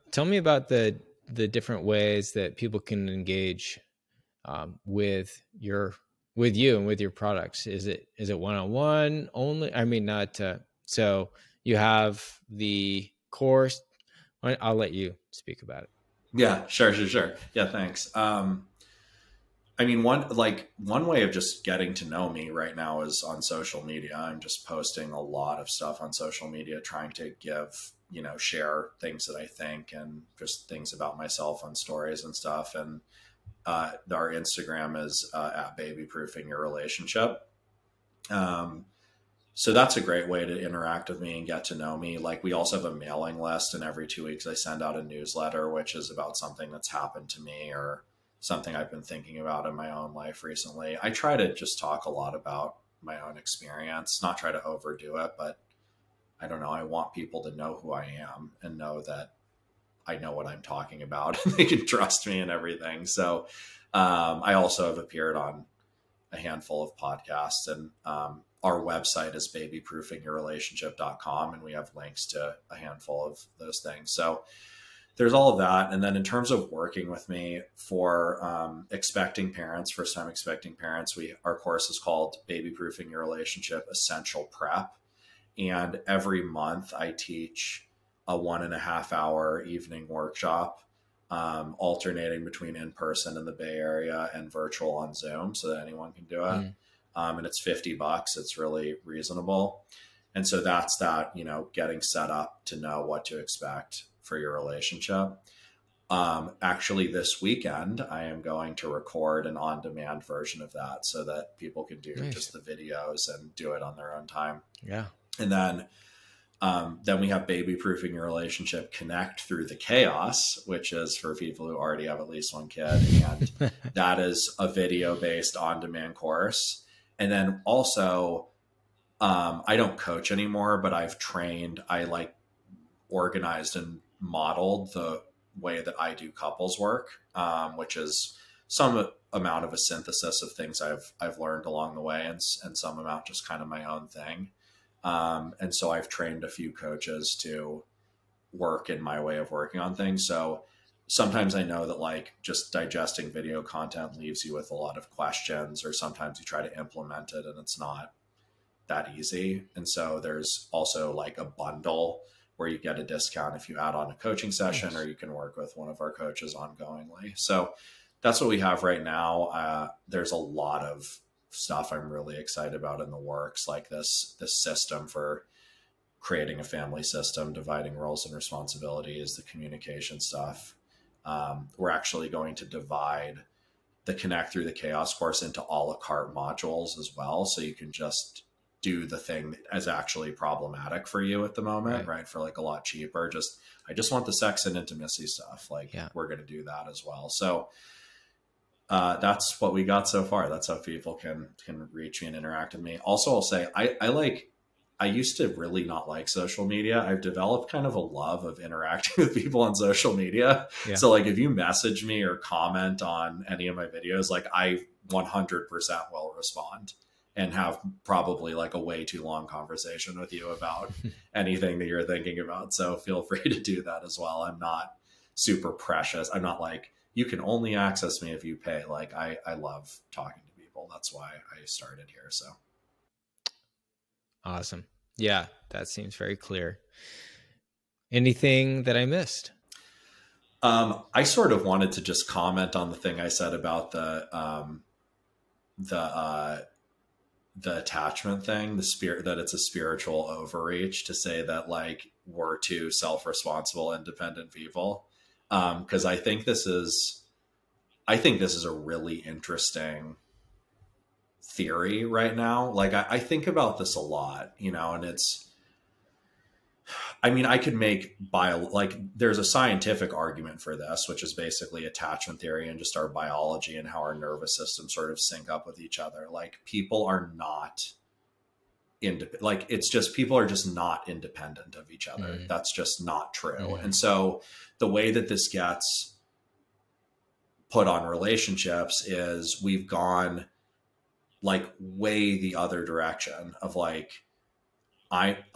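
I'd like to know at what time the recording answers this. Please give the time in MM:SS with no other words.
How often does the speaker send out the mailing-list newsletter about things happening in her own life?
00:43.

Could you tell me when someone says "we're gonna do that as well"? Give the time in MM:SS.
03:16.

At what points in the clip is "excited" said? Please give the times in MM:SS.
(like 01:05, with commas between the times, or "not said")
02:52.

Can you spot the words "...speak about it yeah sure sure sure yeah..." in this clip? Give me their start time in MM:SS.
00:15.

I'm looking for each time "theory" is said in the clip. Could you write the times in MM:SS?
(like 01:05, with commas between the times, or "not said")
04:21, 04:32.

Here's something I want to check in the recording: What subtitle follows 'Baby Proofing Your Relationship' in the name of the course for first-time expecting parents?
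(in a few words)
Essential Prep.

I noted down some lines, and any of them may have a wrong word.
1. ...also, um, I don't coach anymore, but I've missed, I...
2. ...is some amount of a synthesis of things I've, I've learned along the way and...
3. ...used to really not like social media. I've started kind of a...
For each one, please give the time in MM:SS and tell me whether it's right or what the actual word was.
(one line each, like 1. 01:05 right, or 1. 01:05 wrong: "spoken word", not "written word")
1. 02:07 wrong: "trained", not "missed"
2. 02:17 right
3. 03:25 wrong: "developed", not "started".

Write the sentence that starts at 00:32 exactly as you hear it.
And uh, our Instagram is uh, at baby proofing your relationship.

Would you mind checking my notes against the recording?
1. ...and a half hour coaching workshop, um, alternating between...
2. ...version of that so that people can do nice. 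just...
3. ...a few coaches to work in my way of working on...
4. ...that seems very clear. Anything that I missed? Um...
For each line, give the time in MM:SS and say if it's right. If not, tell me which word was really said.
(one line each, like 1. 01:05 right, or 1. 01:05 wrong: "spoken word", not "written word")
1. 01:28 wrong: "evening", not "coaching"
2. 01:50 right
3. 02:26 right
4. 03:55 right.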